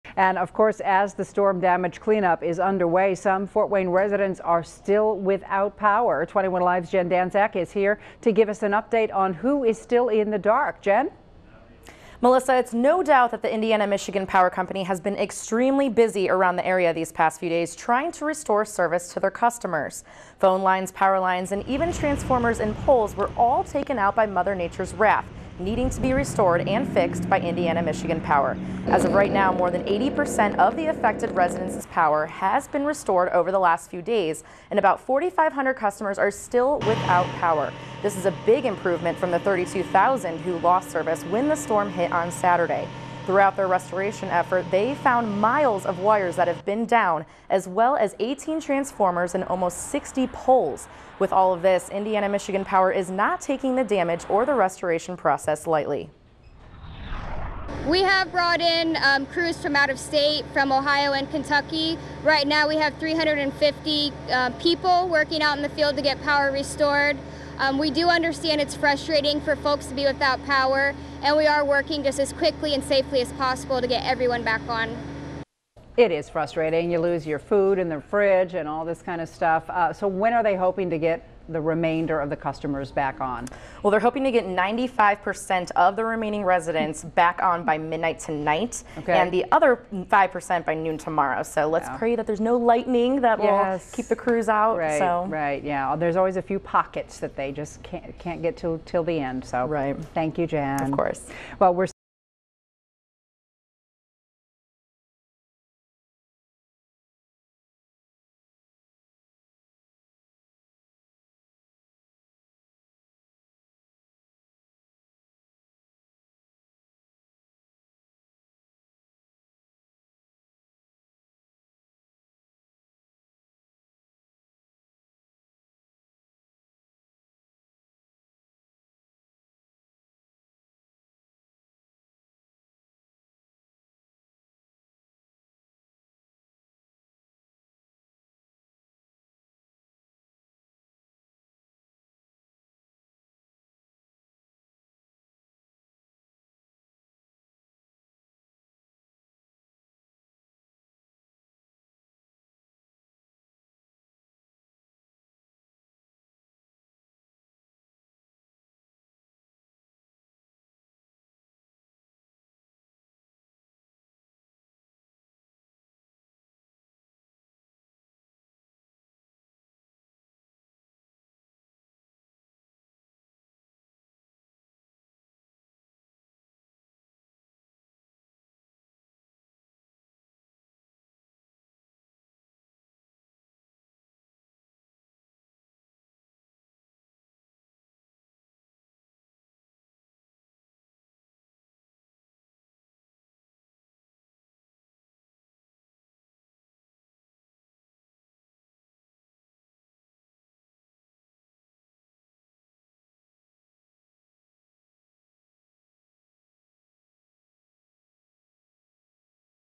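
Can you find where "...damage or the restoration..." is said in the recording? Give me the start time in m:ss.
0:53.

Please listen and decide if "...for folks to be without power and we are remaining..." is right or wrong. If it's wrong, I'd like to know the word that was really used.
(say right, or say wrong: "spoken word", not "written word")
wrong: "working", not "remaining".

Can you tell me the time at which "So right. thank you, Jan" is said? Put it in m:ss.
1:39.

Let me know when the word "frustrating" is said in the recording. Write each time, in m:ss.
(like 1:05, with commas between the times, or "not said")
1:08, 1:16.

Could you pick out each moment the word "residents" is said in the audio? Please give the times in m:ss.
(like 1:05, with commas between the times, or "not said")
0:03, 0:31, 1:26.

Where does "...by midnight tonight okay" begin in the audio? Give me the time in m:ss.
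1:27.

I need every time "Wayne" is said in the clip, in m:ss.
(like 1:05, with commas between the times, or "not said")
0:03.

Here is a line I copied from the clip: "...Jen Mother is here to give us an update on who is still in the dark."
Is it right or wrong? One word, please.
wrong.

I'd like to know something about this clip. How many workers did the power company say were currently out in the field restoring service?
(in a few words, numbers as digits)
350.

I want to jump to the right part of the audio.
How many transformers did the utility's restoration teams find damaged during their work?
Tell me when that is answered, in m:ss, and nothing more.
0:48.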